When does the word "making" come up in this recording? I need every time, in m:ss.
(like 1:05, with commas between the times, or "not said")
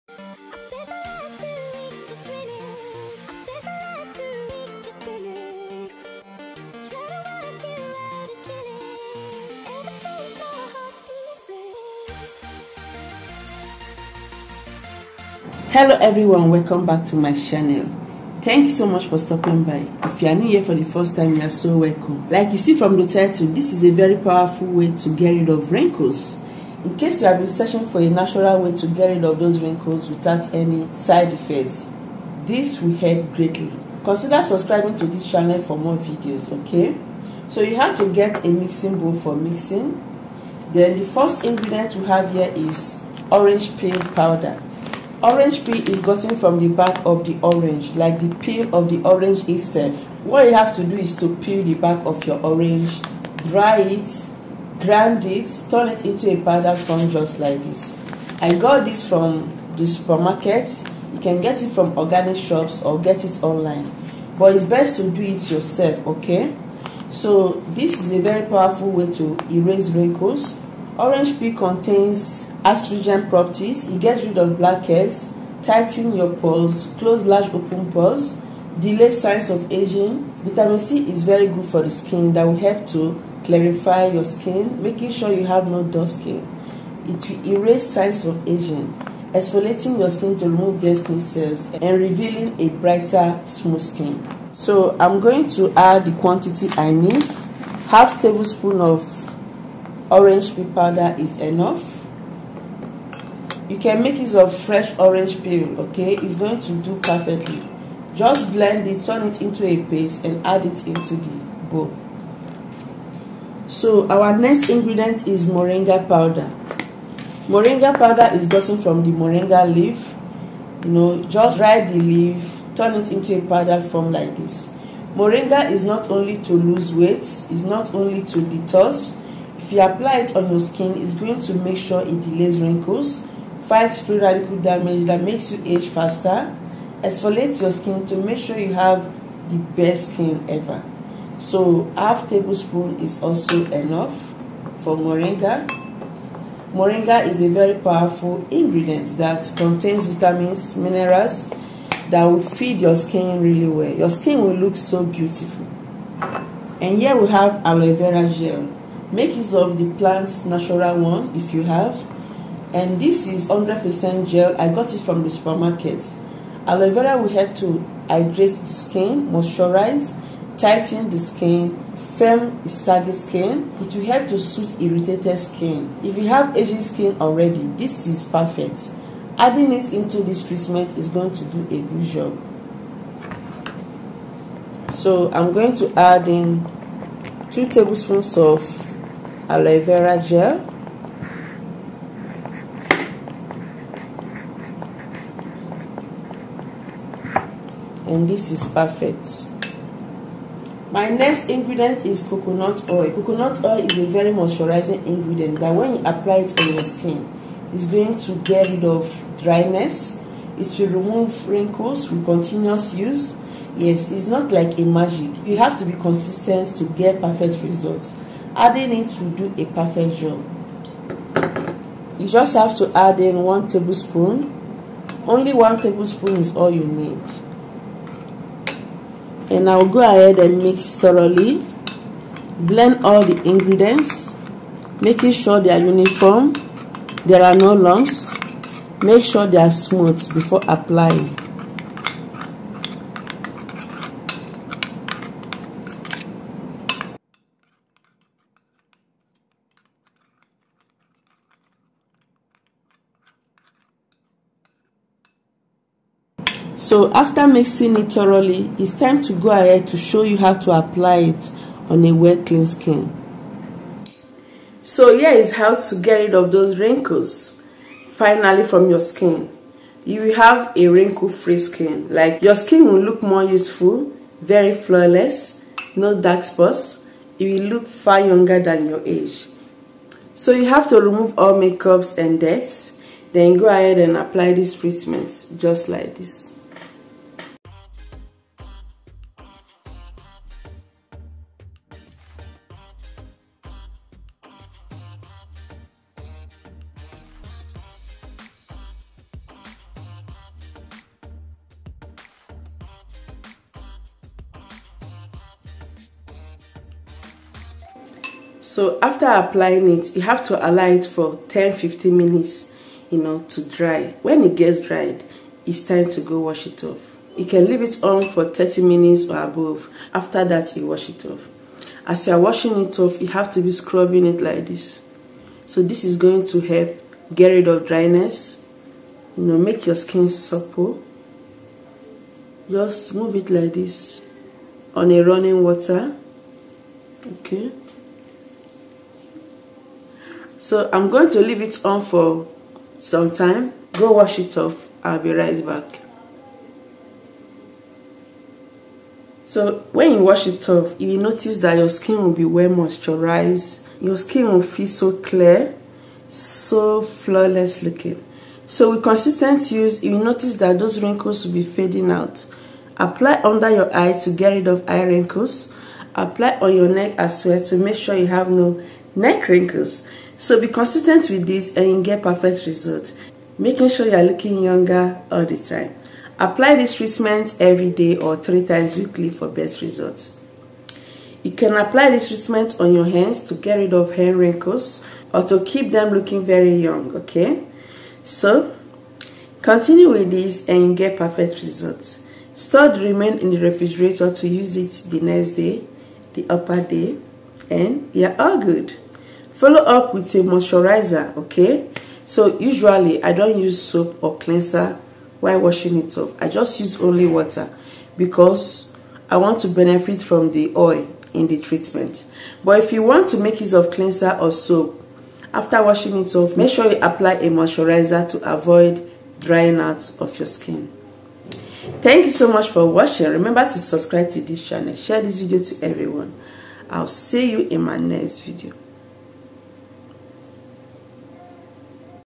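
1:24, 3:55, 6:13.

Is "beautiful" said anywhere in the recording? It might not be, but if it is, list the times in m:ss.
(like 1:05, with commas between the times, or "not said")
2:35.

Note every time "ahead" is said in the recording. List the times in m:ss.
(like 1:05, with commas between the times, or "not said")
3:49, 4:19, 4:43.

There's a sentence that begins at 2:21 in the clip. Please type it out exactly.
So half tablespoon is also enough for moringa.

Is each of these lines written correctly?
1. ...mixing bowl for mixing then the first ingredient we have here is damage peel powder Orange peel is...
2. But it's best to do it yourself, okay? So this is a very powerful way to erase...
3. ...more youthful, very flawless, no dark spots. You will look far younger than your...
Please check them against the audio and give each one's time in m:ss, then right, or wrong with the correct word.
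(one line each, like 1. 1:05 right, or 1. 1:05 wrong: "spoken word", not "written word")
1. 0:38 wrong: "orange", not "damage"
2. 1:04 right
3. 4:33 right.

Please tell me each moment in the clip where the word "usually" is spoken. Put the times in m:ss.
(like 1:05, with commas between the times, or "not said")
6:42.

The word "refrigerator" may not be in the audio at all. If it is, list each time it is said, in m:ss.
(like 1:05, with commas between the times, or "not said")
6:33.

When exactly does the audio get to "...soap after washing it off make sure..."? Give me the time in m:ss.
6:54.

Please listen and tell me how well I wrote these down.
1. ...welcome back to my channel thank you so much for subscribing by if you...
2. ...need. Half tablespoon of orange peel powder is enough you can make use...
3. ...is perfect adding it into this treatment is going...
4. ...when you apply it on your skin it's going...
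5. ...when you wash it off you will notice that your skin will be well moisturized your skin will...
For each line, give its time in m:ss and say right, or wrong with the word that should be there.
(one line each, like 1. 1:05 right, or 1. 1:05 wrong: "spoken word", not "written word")
1. 0:16 wrong: "stopping", not "subscribing"
2. 1:36 right
3. 2:58 right
4. 3:25 right
5. 5:49 right.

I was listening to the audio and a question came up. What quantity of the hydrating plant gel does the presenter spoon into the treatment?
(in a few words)
2 tablespoons.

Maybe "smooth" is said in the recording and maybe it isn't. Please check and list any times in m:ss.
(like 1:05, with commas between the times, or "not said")
1:33, 3:59.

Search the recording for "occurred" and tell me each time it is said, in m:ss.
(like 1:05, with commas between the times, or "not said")
not said.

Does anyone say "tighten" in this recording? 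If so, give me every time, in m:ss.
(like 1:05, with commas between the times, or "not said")
1:15, 2:50.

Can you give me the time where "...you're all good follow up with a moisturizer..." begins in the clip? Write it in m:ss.
6:38.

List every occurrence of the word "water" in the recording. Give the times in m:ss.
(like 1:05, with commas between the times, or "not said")
5:35, 6:47.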